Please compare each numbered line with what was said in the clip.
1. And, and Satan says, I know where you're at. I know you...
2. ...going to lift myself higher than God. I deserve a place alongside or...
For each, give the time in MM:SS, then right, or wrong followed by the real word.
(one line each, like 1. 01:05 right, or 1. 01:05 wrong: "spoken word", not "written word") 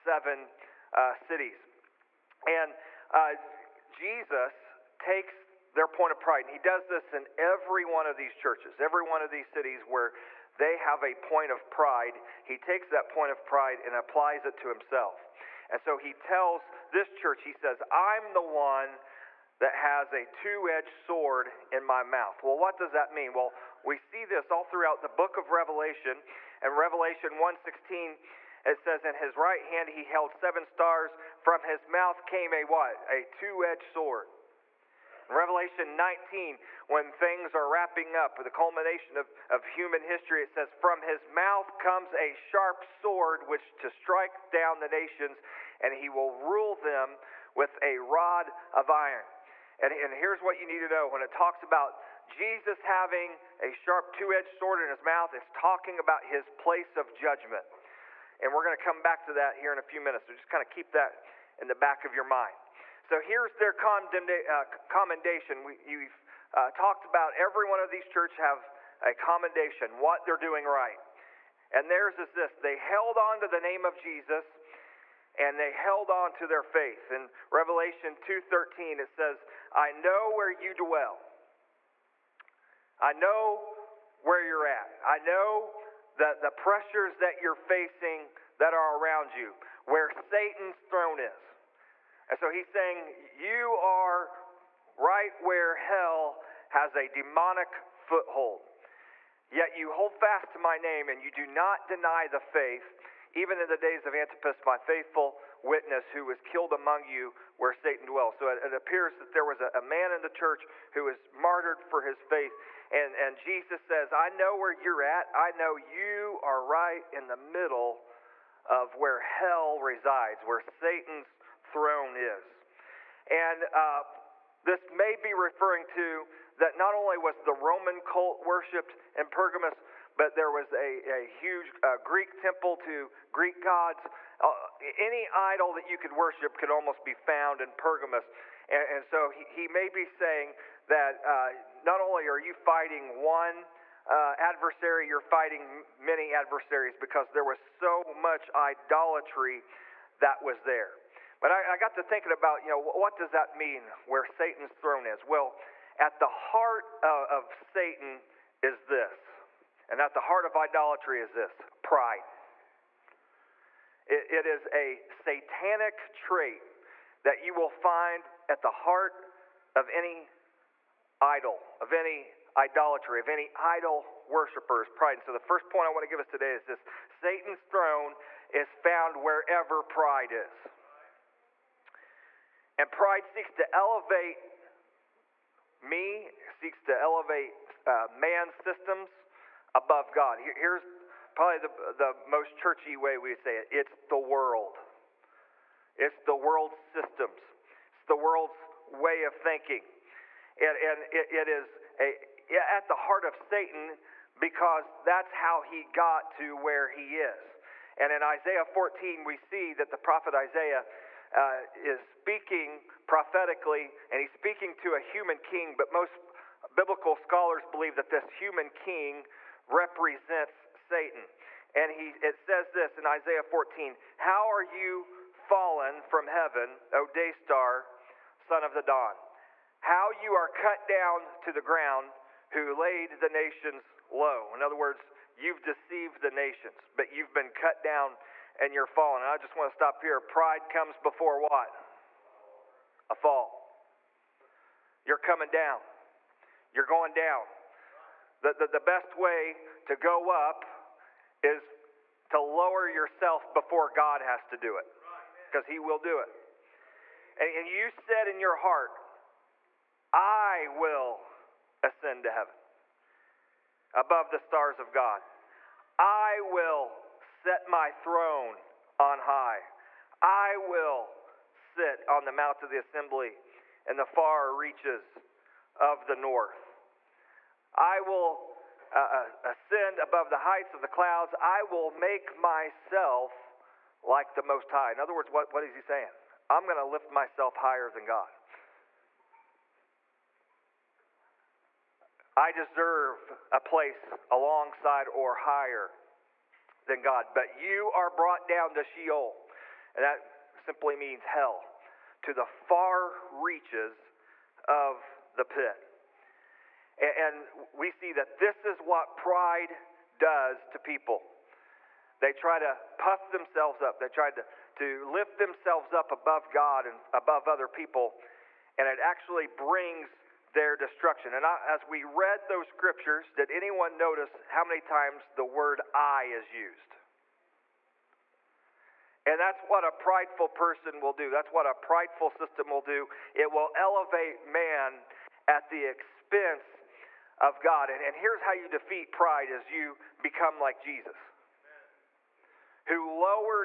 1. 01:52 wrong: "Jesus", not "Satan"
2. 04:46 right.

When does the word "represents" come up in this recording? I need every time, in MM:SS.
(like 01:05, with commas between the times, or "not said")
03:39.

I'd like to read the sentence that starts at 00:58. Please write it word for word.
And we're going to come back to that here in a few minutes.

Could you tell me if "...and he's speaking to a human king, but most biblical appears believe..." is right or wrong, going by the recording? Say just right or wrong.
wrong.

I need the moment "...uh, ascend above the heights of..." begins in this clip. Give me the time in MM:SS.
04:38.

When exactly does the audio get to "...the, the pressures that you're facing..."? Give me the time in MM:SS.
01:26.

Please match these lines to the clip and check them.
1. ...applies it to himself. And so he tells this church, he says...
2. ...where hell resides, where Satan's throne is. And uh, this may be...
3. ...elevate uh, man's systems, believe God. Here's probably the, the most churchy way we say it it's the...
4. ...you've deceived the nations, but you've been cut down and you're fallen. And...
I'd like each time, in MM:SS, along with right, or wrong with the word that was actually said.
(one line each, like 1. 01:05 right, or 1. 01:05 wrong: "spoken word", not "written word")
1. 00:13 right
2. 01:58 right
3. 03:06 wrong: "above", not "believe"
4. 03:55 right.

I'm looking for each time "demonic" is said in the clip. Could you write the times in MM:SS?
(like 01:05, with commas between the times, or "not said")
01:37.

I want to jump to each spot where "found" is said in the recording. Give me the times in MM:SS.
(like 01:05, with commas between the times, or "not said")
02:17, 02:58.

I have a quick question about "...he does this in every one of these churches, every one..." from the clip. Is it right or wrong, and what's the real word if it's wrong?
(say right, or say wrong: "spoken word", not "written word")
right.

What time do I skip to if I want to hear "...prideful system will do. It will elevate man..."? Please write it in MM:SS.
05:31.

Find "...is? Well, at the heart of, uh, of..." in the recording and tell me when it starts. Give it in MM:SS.
02:35.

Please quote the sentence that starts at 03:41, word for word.
And he, it says this in Isaiah 14 How are you fallen from heaven, O day star, son of the dawn?